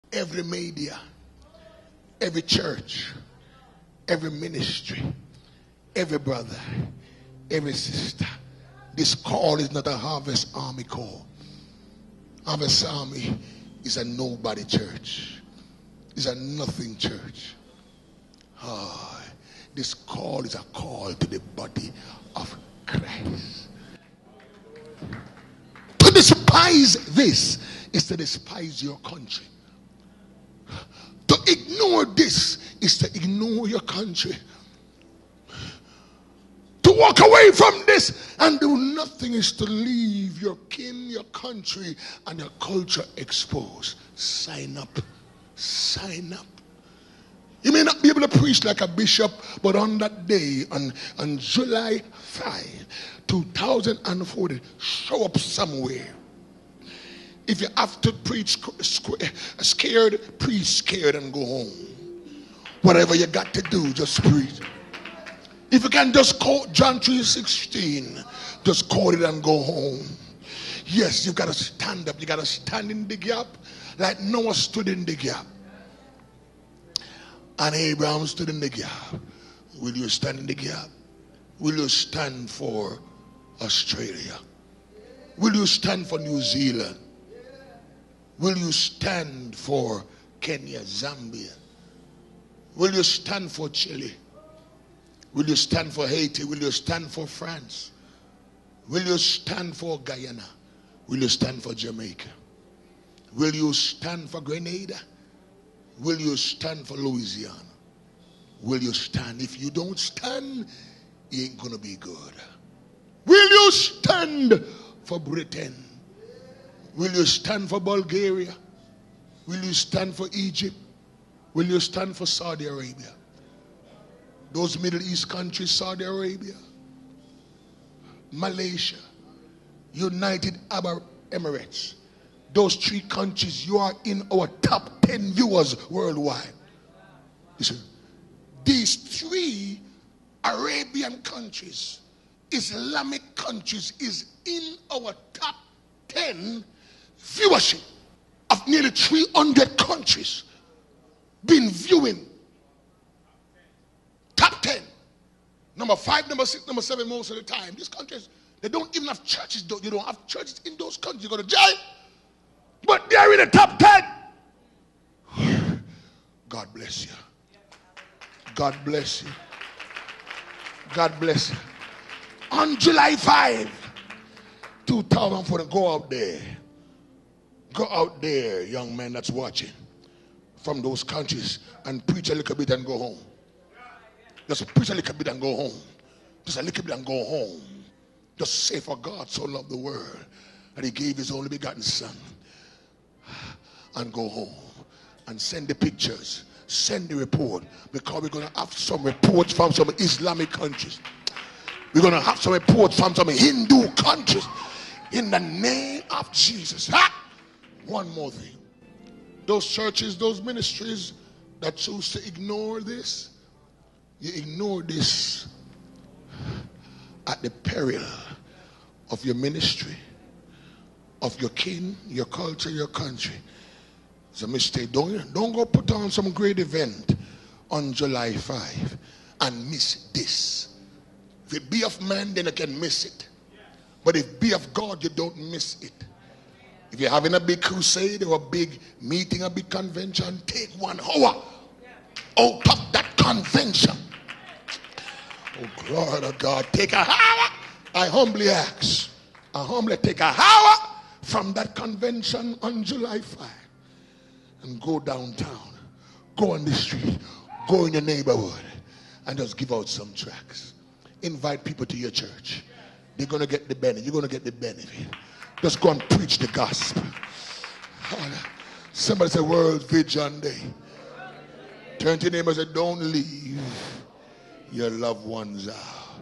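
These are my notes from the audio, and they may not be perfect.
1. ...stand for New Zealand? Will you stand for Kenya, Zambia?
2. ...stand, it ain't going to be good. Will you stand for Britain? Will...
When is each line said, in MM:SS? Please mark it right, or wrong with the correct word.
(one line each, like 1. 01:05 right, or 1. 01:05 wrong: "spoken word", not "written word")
1. 01:25 right
2. 01:49 right.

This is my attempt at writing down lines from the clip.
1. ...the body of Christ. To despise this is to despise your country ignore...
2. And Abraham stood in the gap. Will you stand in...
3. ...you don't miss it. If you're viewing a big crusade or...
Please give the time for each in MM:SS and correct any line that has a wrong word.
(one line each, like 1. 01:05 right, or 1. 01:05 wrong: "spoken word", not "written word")
1. 00:21 right
2. 01:17 right
3. 03:55 wrong: "having", not "viewing".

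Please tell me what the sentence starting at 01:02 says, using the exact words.
Whatever you got to do, just preach.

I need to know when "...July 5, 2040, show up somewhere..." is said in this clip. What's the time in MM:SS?
00:51.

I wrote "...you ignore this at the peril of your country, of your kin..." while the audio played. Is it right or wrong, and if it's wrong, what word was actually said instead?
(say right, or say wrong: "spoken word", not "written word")
wrong: "ministry", not "country".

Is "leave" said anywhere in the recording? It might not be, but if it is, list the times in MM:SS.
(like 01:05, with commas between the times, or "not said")
00:39, 04:32.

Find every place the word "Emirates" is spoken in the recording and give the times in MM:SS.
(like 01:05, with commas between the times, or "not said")
02:11.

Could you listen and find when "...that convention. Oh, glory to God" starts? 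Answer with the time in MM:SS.
04:02.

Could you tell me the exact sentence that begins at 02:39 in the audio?
You don't have churches in those countries.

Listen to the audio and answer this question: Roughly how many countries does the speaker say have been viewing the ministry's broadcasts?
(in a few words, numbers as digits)
300.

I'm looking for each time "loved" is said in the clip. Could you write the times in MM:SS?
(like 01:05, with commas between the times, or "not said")
03:09, 04:34.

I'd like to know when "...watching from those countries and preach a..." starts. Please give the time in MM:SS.
02:59.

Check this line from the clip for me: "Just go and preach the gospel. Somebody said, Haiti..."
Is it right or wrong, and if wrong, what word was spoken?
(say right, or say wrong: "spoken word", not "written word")
wrong: "World", not "Haiti".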